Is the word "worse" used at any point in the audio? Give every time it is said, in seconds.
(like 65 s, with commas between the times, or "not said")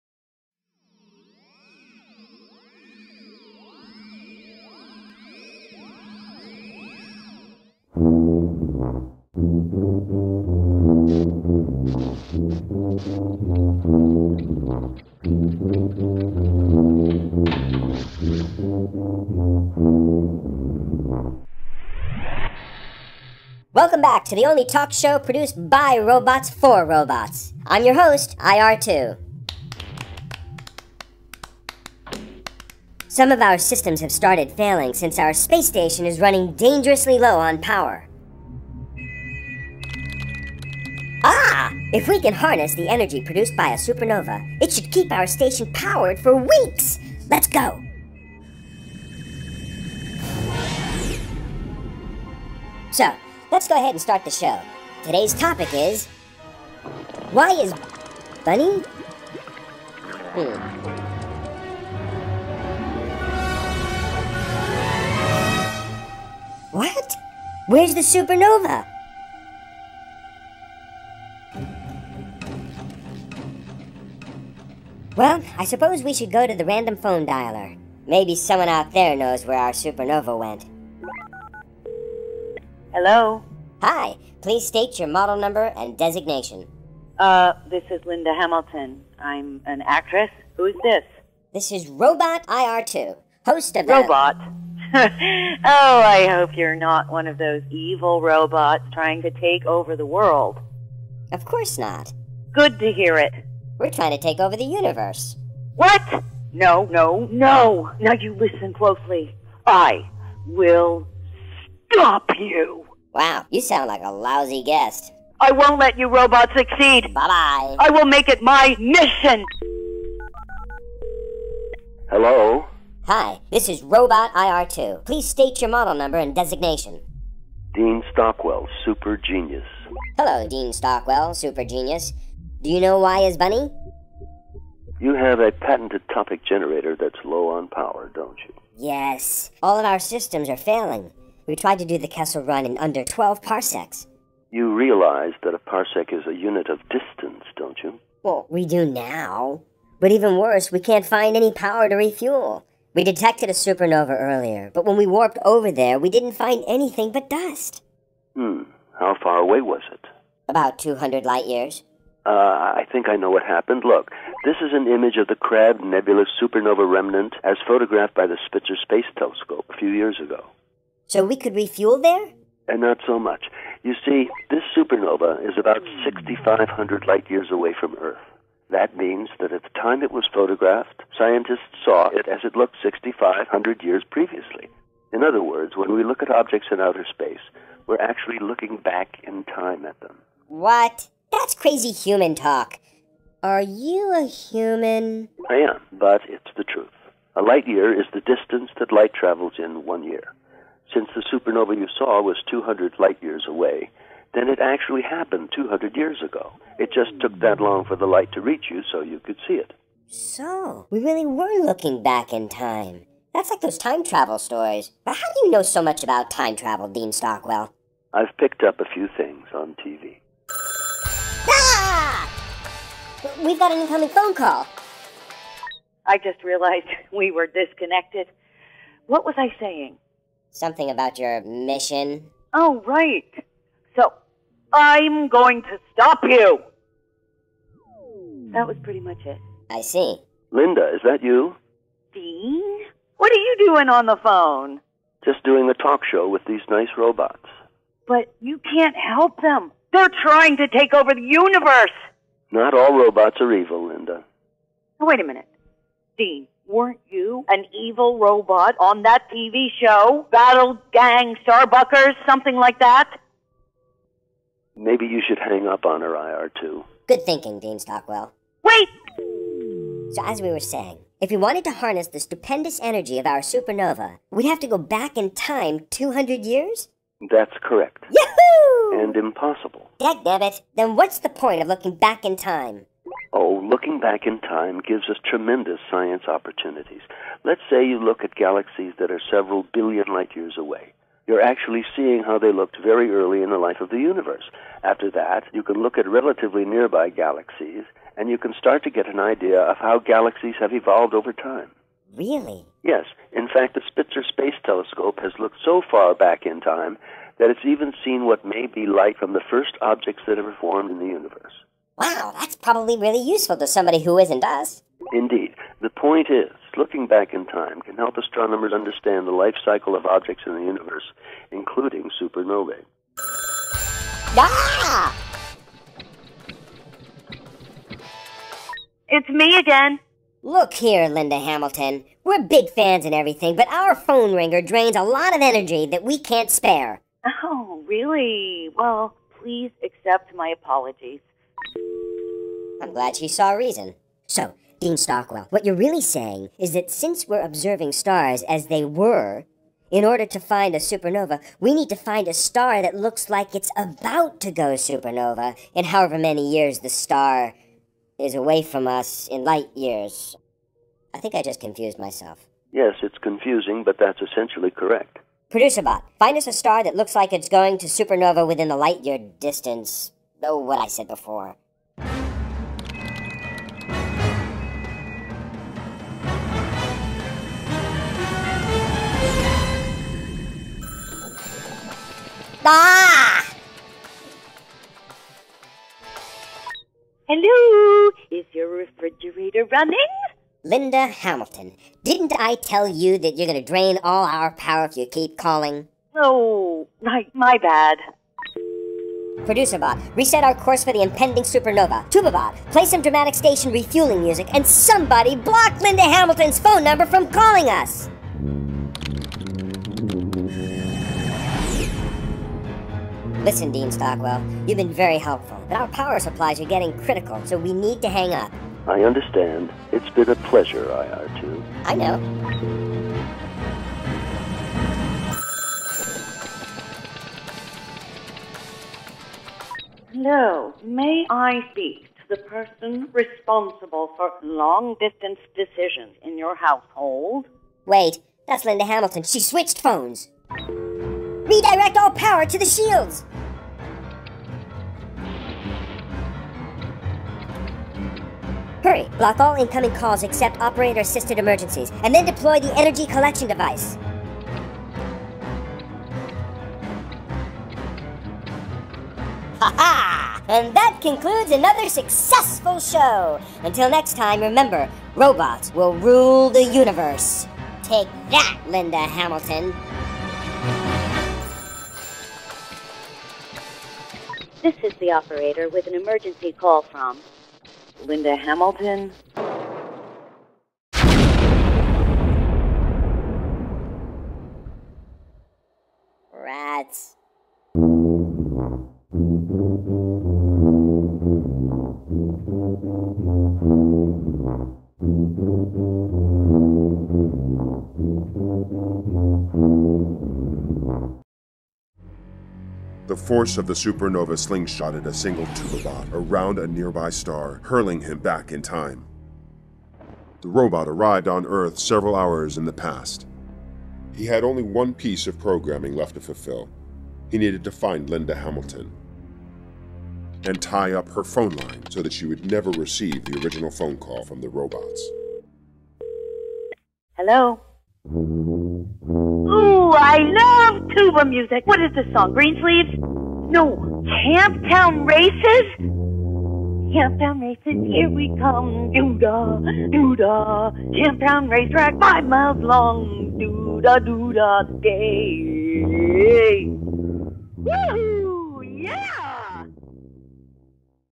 150 s.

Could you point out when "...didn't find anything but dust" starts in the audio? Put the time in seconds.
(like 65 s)
156 s.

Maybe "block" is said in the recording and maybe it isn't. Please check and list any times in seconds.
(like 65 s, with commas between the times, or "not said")
405 s, 449 s.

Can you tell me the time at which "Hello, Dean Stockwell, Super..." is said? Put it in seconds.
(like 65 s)
130 s.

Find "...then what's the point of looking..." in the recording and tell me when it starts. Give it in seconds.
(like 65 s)
280 s.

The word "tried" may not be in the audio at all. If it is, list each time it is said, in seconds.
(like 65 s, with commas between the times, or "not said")
141 s.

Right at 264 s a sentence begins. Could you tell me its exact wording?
Maybe you should hang up on her, IR2.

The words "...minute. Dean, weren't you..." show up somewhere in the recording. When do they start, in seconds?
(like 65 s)
255 s.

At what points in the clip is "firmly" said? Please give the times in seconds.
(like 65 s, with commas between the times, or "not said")
not said.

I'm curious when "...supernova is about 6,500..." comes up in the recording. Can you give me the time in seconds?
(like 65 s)
174 s.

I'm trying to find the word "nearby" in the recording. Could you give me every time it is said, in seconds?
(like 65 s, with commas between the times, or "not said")
296 s, 506 s.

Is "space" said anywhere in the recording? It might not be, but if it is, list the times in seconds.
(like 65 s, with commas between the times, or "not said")
168 s, 187 s, 304 s.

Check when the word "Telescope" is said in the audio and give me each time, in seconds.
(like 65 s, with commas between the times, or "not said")
169 s, 304 s.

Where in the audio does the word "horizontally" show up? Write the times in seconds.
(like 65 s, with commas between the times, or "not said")
not said.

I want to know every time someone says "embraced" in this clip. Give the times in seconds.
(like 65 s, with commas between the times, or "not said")
not said.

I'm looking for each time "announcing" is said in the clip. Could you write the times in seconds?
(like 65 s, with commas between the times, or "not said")
not said.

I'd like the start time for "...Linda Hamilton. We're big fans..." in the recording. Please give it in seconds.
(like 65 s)
331 s.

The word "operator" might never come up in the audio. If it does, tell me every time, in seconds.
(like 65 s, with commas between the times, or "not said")
450 s, 475 s.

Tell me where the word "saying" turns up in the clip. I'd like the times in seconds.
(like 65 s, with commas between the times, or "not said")
229 s, 270 s, 346 s.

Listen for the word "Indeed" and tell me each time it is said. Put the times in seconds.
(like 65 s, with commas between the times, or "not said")
315 s.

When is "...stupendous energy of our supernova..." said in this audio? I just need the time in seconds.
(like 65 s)
272 s.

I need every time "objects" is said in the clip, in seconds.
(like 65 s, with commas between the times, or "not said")
186 s, 309 s, 320 s.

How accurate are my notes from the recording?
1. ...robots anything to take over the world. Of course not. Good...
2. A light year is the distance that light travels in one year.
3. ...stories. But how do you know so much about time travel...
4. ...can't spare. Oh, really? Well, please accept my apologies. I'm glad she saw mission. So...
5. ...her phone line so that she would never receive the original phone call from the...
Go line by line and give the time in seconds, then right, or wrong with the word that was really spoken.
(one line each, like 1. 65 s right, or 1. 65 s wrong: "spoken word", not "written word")
1. 98 s wrong: "trying", not "anything"
2. 197 s right
3. 214 s right
4. 336 s wrong: "reason", not "mission"
5. 521 s right.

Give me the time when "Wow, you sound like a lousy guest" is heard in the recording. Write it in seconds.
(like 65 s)
113 s.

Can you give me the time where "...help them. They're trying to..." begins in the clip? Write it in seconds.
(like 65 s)
248 s.